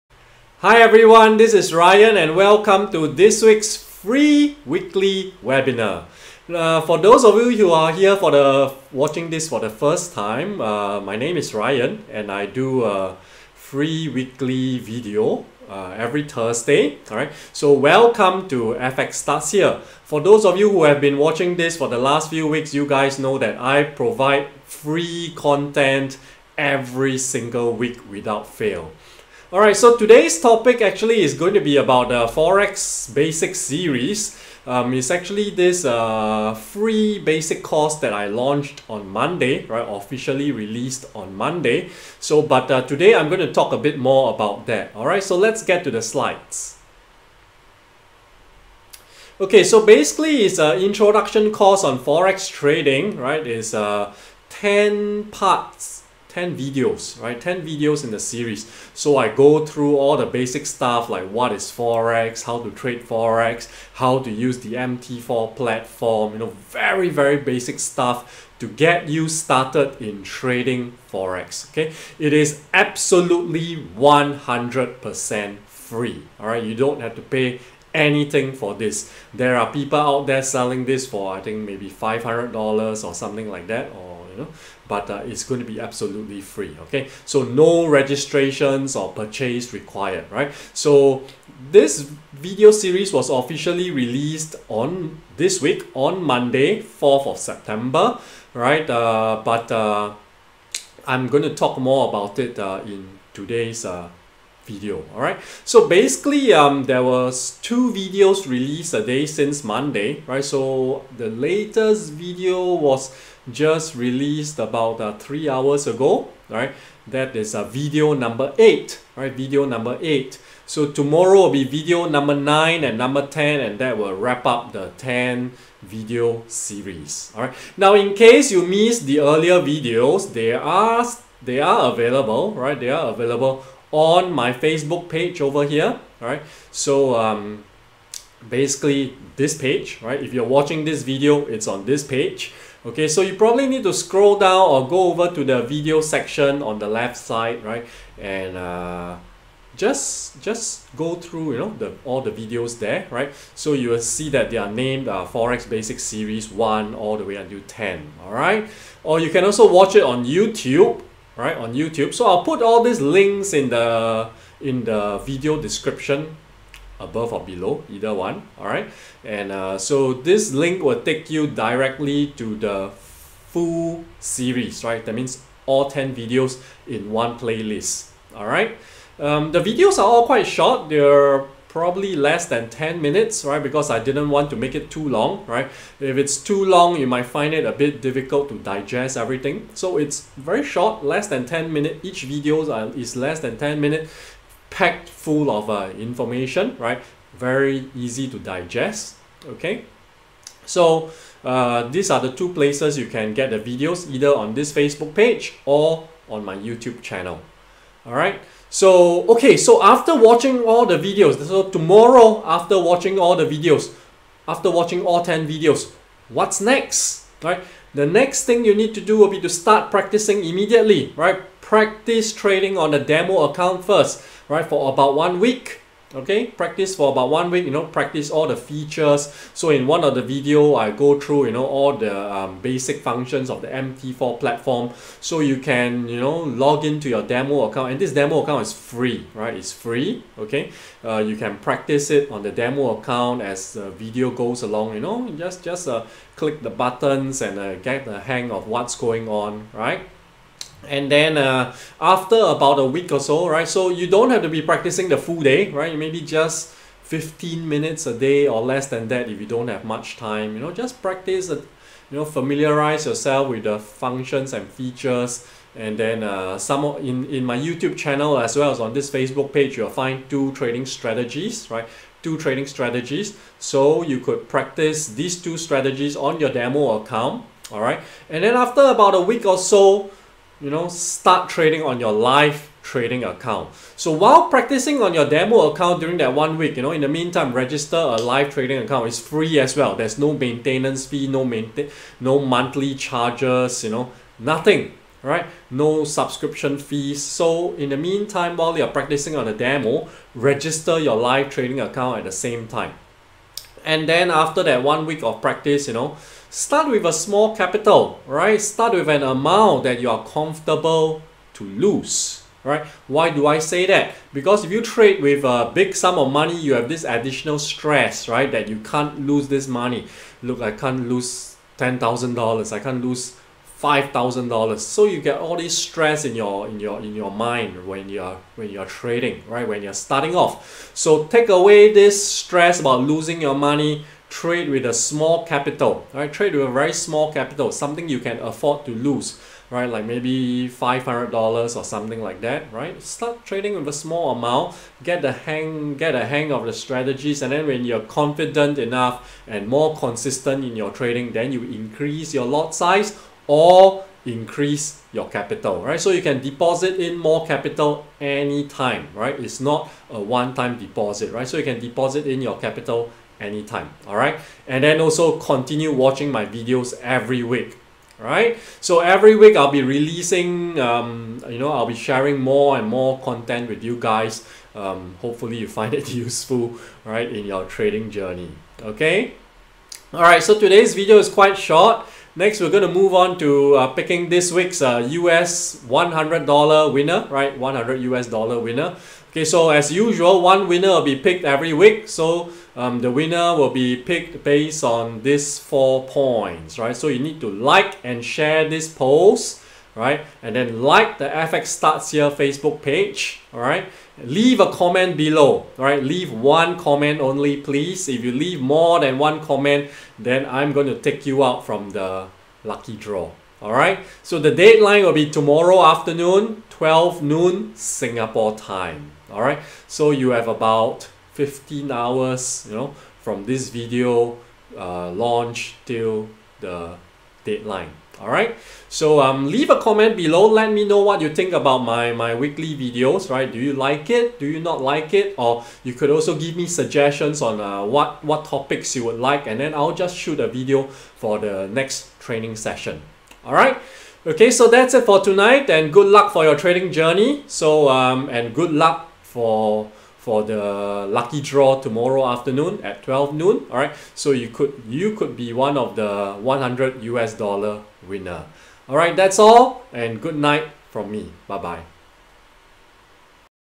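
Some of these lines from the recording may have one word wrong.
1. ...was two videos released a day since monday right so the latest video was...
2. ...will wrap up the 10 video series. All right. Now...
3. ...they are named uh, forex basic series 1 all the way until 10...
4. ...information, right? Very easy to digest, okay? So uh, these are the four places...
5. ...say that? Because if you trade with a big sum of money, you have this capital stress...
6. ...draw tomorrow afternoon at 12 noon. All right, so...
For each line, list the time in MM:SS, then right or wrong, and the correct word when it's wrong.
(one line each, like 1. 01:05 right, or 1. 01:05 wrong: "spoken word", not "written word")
1. 01:47 right
2. 02:03 right
3. 02:34 right
4. 03:15 wrong: "two", not "four"
5. 05:13 wrong: "additional", not "capital"
6. 07:31 right.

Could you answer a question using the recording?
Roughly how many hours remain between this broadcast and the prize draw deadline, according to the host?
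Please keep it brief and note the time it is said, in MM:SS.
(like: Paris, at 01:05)
15 hours, at 07:01.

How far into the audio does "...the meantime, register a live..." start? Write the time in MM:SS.
04:47.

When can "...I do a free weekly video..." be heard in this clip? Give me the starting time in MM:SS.
00:12.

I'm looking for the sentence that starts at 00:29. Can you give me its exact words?
Alright, so today's topic actually is going to be about the Forex Basic Series.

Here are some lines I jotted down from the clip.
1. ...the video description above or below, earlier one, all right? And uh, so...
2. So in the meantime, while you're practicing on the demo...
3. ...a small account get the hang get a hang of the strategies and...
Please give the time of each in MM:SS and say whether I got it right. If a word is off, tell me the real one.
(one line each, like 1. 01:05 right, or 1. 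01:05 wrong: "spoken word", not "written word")
1. 02:44 wrong: "either", not "earlier"
2. 04:57 right
3. 05:43 wrong: "amount", not "account".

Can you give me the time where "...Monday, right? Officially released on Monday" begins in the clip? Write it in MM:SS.
00:39.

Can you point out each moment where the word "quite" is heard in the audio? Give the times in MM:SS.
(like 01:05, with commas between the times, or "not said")
03:00, 06:21.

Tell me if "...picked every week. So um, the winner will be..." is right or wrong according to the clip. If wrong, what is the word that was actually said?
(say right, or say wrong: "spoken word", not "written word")
right.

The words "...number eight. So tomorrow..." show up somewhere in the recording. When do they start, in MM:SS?
01:59.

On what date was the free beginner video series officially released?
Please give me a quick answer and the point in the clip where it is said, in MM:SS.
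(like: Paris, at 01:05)
4th of September, at 01:36.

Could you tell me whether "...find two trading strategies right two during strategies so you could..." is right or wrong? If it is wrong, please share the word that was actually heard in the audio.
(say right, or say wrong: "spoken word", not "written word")
wrong: "trading", not "during".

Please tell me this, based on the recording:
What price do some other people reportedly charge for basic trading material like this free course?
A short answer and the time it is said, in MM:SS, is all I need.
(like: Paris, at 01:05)
$500, at 01:21.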